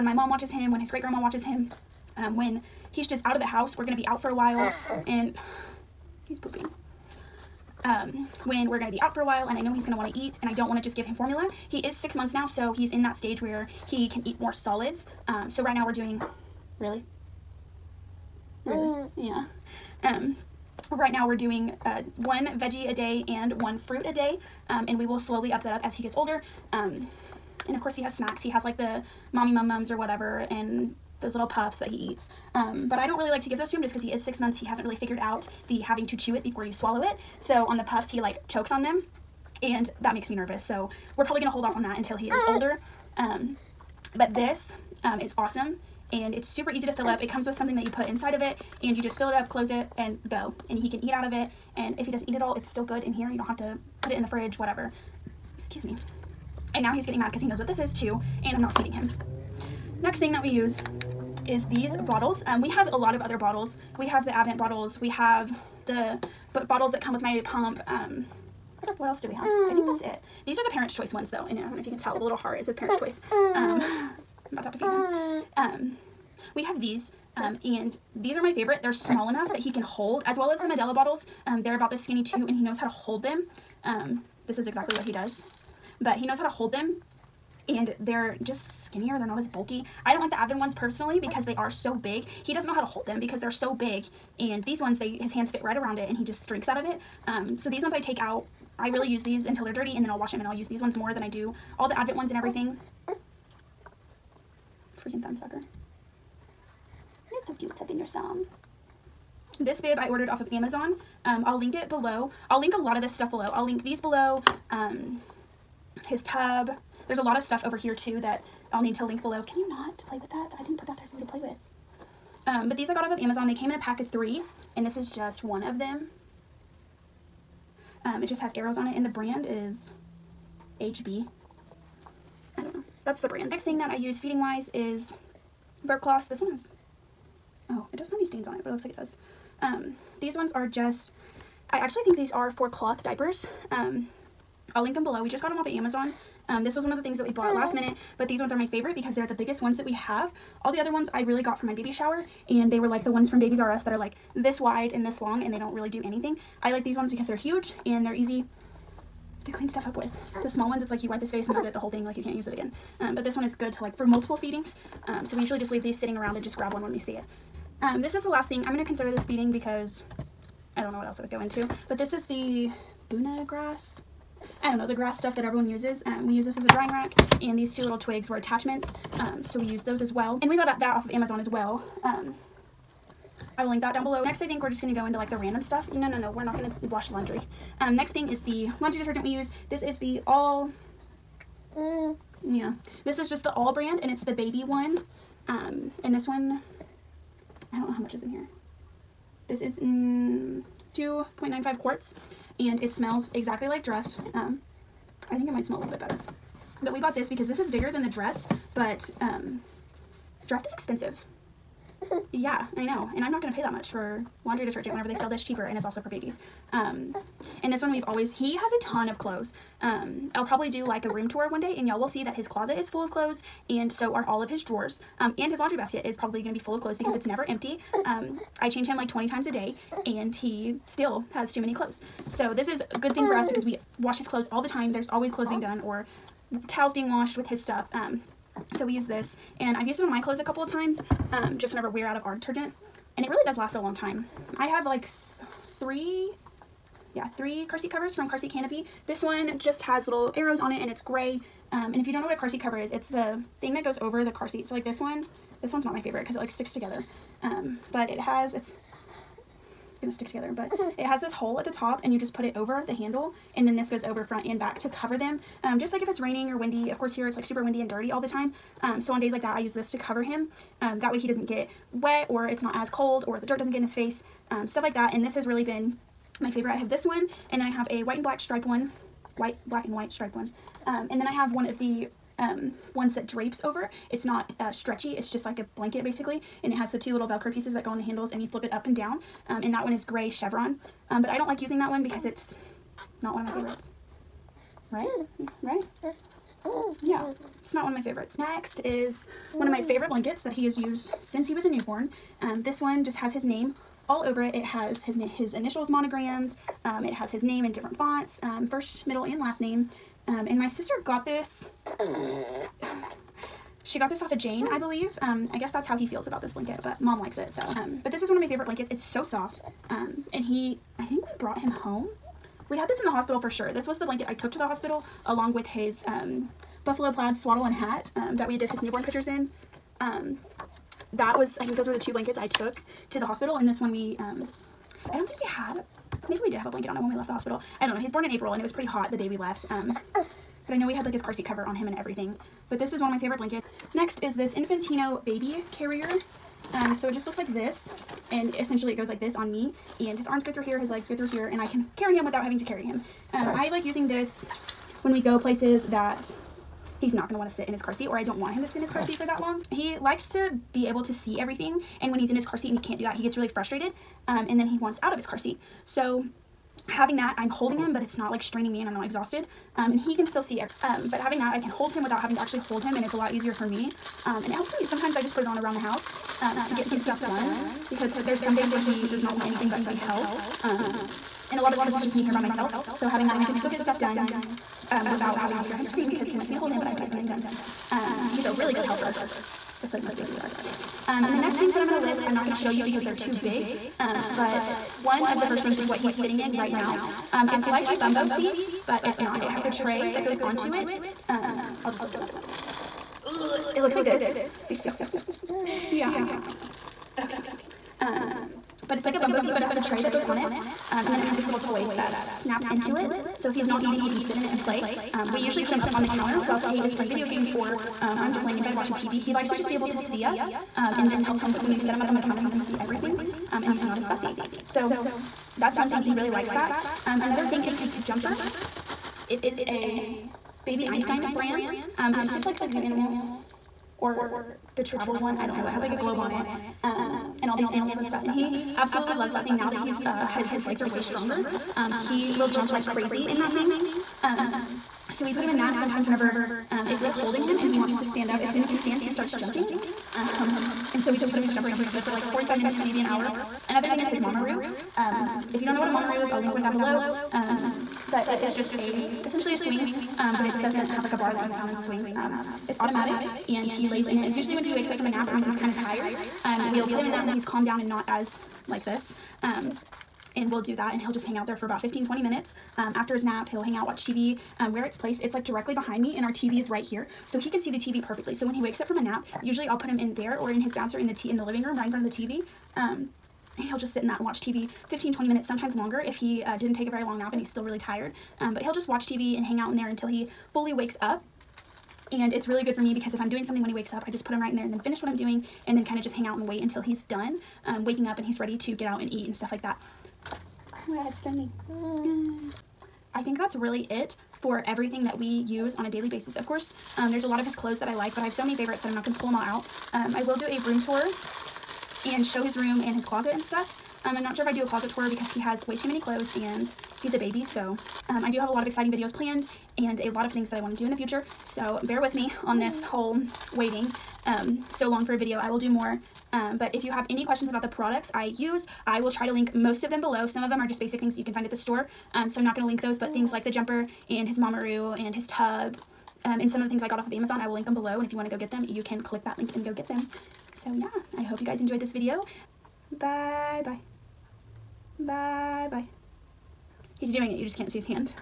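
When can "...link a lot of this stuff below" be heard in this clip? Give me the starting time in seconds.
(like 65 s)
112 s.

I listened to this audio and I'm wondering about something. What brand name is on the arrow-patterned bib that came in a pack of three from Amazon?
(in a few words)
HB.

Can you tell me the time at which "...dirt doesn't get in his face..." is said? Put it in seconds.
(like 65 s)
273 s.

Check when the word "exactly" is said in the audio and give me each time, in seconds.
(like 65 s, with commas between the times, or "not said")
84 s, 203 s.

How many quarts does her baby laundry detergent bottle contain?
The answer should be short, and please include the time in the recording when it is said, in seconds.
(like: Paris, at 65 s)
2.95 quarts, at 200 s.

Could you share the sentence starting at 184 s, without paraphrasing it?
Next, I think we're just going to go into like the random stuff.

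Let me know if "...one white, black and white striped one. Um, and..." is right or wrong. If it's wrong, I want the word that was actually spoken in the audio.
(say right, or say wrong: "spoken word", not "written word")
right.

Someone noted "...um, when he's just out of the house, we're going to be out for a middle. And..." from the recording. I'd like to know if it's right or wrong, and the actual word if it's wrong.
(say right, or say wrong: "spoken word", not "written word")
wrong: "while", not "middle".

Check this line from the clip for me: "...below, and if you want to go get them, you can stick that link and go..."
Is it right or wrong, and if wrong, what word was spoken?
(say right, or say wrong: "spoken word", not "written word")
wrong: "click", not "stick".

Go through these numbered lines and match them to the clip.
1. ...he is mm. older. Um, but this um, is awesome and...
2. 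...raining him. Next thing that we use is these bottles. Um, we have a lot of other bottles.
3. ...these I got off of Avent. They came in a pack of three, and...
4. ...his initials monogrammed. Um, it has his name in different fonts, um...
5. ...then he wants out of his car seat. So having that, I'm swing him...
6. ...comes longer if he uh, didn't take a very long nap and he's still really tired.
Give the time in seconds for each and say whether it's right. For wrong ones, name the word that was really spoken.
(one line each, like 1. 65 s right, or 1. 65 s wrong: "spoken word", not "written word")
1. 42 s right
2. 58 s wrong: "feeding", not "raining"
3. 122 s wrong: "Amazon", not "Avent"
4. 305 s right
5. 364 s wrong: "holding", not "swing"
6. 485 s wrong: "sometimes", not "comes".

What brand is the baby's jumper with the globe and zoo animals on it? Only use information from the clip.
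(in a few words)
Baby Einstein.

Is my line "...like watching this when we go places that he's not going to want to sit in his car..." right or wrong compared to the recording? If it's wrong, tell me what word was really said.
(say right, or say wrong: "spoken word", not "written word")
wrong: "using", not "watching".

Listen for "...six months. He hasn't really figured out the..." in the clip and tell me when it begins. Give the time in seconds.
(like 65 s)
34 s.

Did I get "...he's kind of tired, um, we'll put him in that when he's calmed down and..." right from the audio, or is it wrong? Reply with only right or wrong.
right.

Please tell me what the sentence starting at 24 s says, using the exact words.
Um, and we will slowly up that up as he gets older.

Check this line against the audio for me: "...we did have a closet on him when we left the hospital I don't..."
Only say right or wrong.
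wrong.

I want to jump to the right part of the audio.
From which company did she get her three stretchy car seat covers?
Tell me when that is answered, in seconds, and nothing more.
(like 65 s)
248 s.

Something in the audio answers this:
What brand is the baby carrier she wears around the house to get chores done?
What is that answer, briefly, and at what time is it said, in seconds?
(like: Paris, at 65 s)
Infantino, at 344 s.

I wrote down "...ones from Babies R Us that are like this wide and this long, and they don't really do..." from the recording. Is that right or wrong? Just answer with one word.
right.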